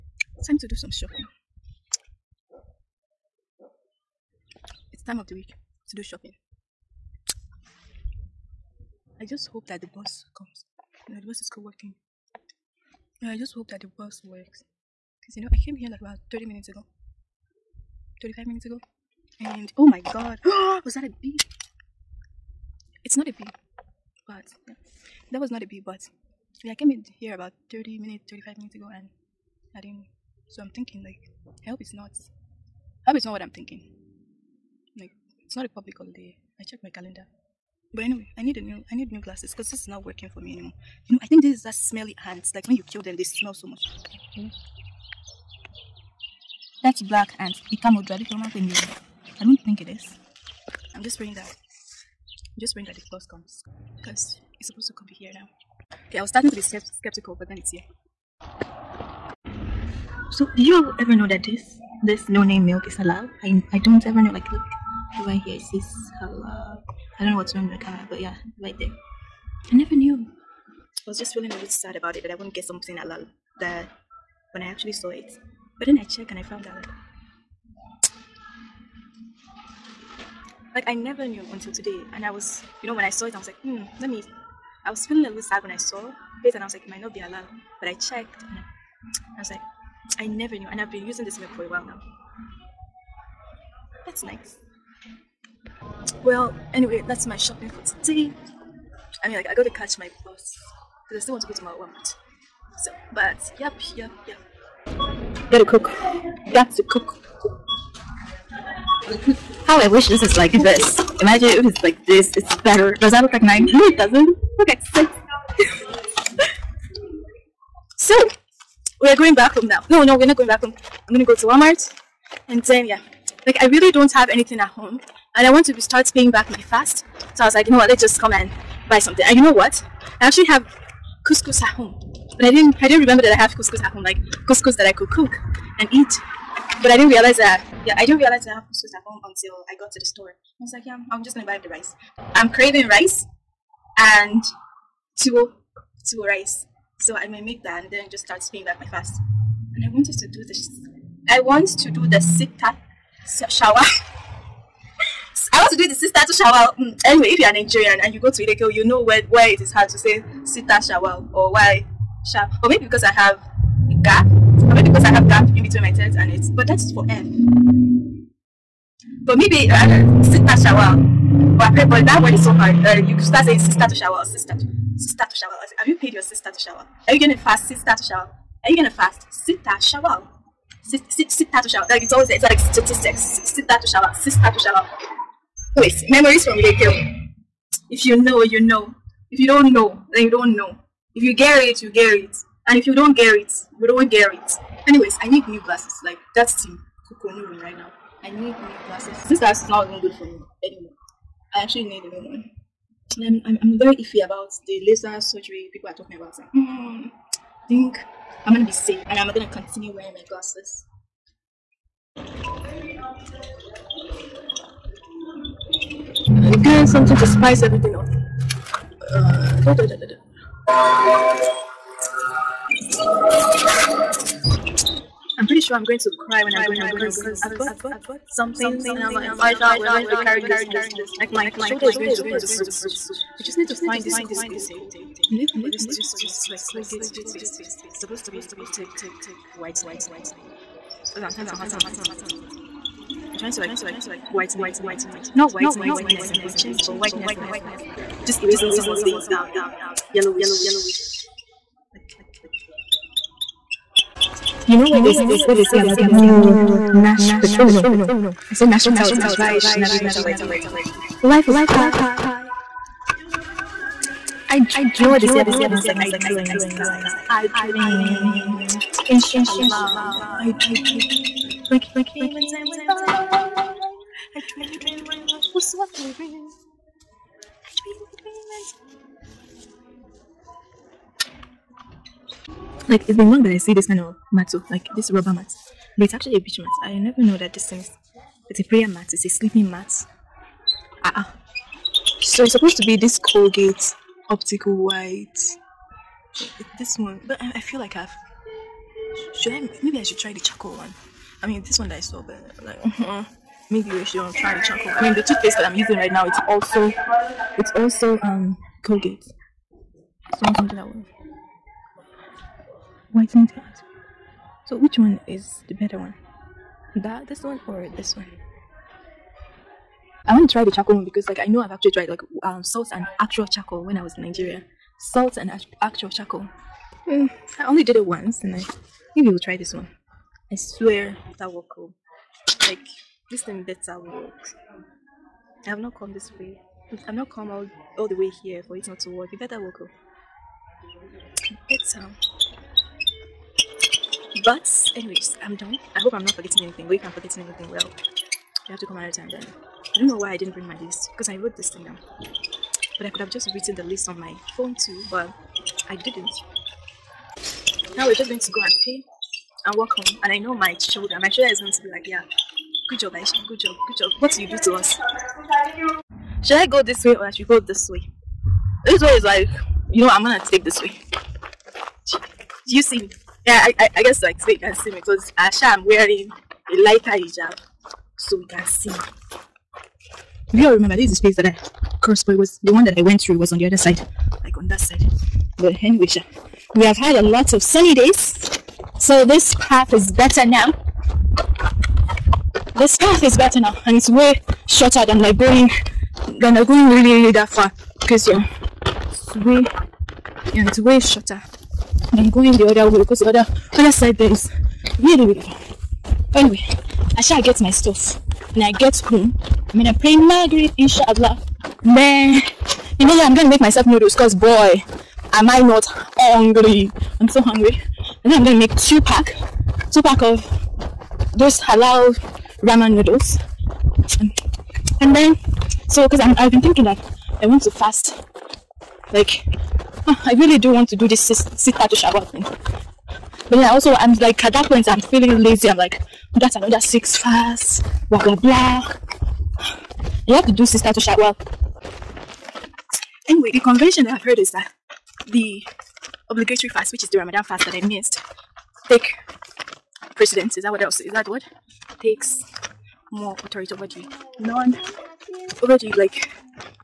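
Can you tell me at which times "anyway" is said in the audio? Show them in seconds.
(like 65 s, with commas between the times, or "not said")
38 s, 96 s, 157 s, 194 s, 344 s, 385 s, 406 s, 443 s.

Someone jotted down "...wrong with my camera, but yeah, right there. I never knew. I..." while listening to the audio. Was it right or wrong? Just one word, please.
right.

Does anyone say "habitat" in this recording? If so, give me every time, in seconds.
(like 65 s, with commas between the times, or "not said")
not said.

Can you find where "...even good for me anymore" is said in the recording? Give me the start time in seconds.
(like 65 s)
199 s.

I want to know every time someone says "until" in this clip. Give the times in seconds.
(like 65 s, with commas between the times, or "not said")
81 s, 139 s.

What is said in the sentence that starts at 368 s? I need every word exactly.
This way is like, you know, I'm gonna take this way.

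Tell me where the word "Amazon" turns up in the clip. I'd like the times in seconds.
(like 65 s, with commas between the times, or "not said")
not said.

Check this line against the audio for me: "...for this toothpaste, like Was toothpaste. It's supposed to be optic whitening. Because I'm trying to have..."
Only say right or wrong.
wrong.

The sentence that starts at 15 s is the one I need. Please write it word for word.
Because, you know, I came here like about 30 minutes ago.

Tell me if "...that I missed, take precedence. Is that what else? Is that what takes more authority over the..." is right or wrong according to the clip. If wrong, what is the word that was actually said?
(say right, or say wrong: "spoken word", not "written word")
right.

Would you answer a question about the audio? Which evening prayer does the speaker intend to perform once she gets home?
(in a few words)
Maghrib.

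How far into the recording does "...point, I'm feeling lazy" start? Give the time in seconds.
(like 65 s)
434 s.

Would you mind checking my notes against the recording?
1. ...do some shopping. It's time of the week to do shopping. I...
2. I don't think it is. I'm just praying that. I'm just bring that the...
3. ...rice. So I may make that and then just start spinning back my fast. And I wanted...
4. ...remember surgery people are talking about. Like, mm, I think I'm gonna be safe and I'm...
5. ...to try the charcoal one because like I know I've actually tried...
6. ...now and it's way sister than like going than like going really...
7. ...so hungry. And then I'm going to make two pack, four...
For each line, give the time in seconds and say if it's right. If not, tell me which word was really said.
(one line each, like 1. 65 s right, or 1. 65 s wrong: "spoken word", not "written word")
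1. 0 s right
2. 49 s wrong: "praying", not "bring"
3. 146 s right
4. 204 s wrong: "laser", not "remember"
5. 320 s right
6. 393 s wrong: "shorter", not "sister"
7. 417 s wrong: "two", not "four".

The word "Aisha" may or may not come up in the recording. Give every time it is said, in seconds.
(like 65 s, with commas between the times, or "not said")
229 s, 363 s.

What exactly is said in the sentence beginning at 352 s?
But I could have just written the list on my phone too, but I didn't.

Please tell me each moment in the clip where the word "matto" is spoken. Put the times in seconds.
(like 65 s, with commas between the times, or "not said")
284 s.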